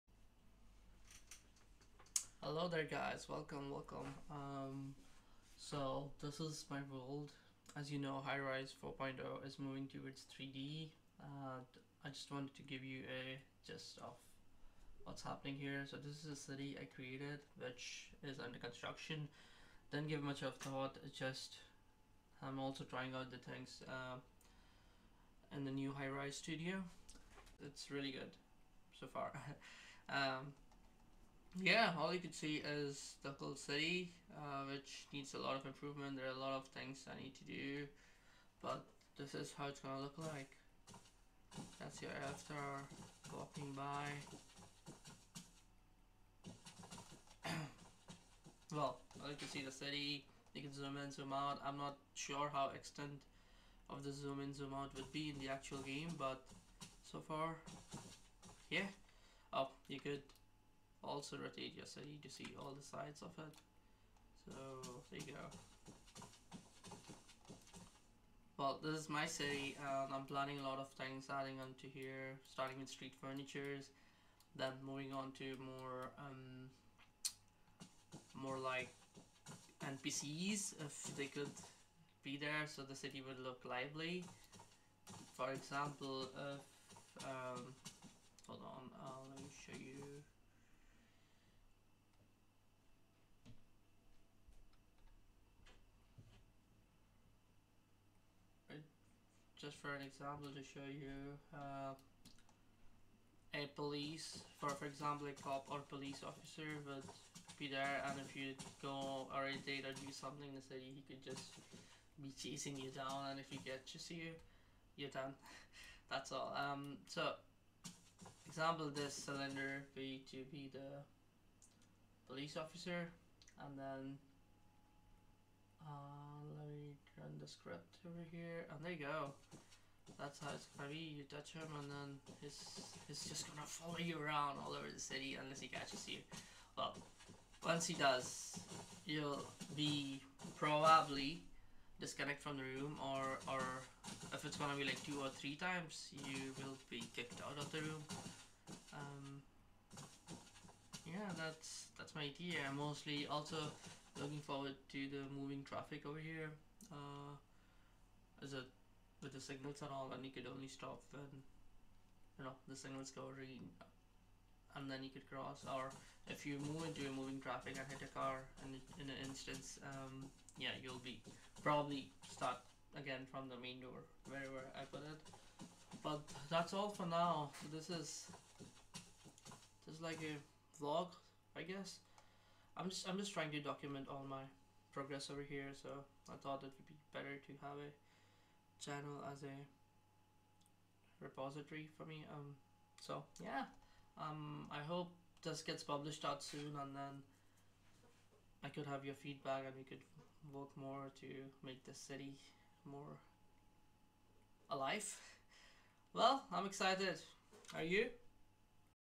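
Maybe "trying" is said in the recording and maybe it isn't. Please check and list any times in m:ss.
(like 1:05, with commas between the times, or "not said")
0:22, 3:03.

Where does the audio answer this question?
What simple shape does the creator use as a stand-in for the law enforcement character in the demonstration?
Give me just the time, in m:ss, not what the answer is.
1:59.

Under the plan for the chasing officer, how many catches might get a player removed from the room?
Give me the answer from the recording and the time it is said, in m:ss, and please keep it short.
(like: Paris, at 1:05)
2 or 3, at 2:25.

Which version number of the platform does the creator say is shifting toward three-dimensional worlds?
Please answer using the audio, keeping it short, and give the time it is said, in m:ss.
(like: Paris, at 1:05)
4.0, at 0:08.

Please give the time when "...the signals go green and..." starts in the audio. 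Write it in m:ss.
2:42.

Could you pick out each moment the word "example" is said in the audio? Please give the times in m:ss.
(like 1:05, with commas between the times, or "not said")
1:25, 1:40, 1:44, 1:58.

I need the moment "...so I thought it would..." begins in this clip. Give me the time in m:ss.
3:05.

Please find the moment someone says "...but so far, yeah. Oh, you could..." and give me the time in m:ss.
0:56.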